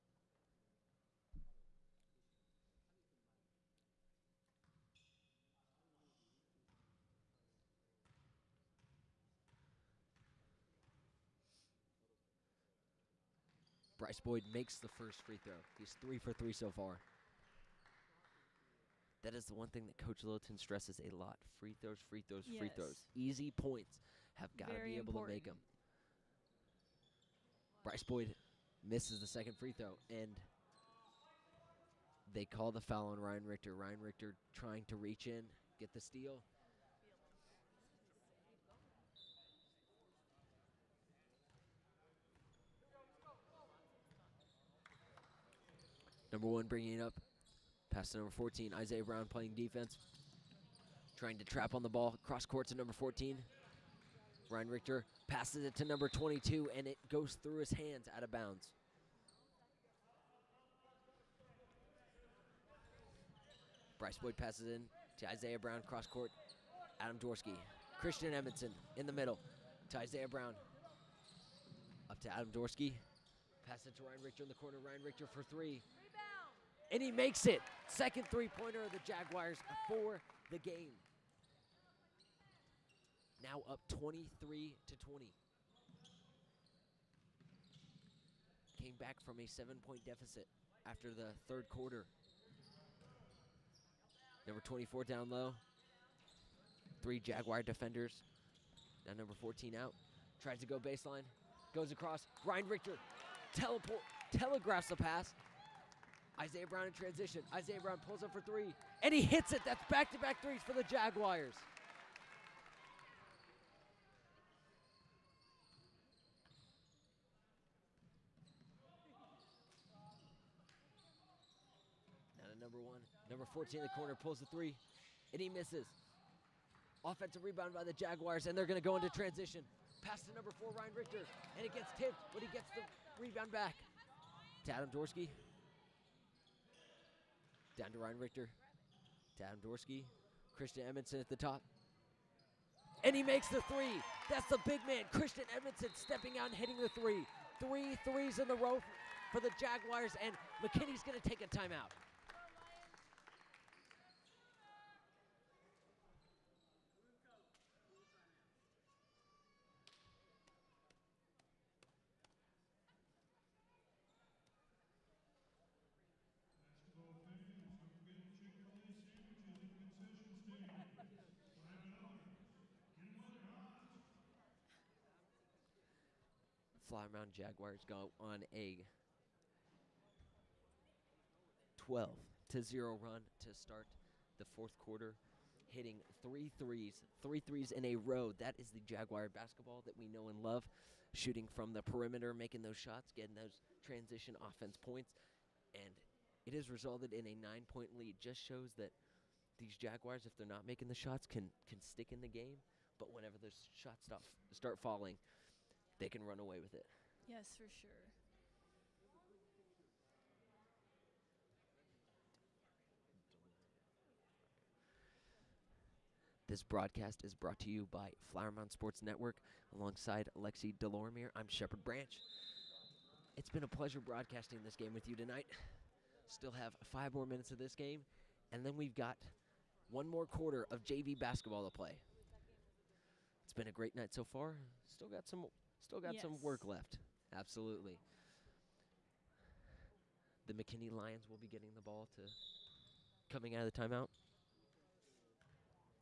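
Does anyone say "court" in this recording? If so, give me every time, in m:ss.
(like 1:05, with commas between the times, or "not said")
0:52, 1:06.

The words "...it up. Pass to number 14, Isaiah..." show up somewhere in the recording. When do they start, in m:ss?
0:46.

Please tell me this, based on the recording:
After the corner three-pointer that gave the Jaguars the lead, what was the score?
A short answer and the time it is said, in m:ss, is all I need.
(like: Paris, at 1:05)
23 to 20, at 1:23.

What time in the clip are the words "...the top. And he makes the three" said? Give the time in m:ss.
2:21.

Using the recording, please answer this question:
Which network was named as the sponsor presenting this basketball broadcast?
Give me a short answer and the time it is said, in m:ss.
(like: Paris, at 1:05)
Flower Mound Sports Network, at 3:38.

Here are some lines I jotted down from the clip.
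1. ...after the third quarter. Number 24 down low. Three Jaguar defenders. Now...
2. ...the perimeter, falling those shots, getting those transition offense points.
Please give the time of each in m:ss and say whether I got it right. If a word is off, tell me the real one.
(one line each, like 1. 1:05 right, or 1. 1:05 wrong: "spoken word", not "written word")
1. 1:30 right
2. 3:11 wrong: "making", not "falling".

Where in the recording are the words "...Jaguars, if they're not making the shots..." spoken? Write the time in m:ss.
3:19.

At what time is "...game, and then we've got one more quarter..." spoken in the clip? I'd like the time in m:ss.
3:47.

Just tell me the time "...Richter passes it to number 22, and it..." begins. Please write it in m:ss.
0:54.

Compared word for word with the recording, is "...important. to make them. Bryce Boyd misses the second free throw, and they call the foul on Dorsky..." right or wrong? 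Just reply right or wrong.
wrong.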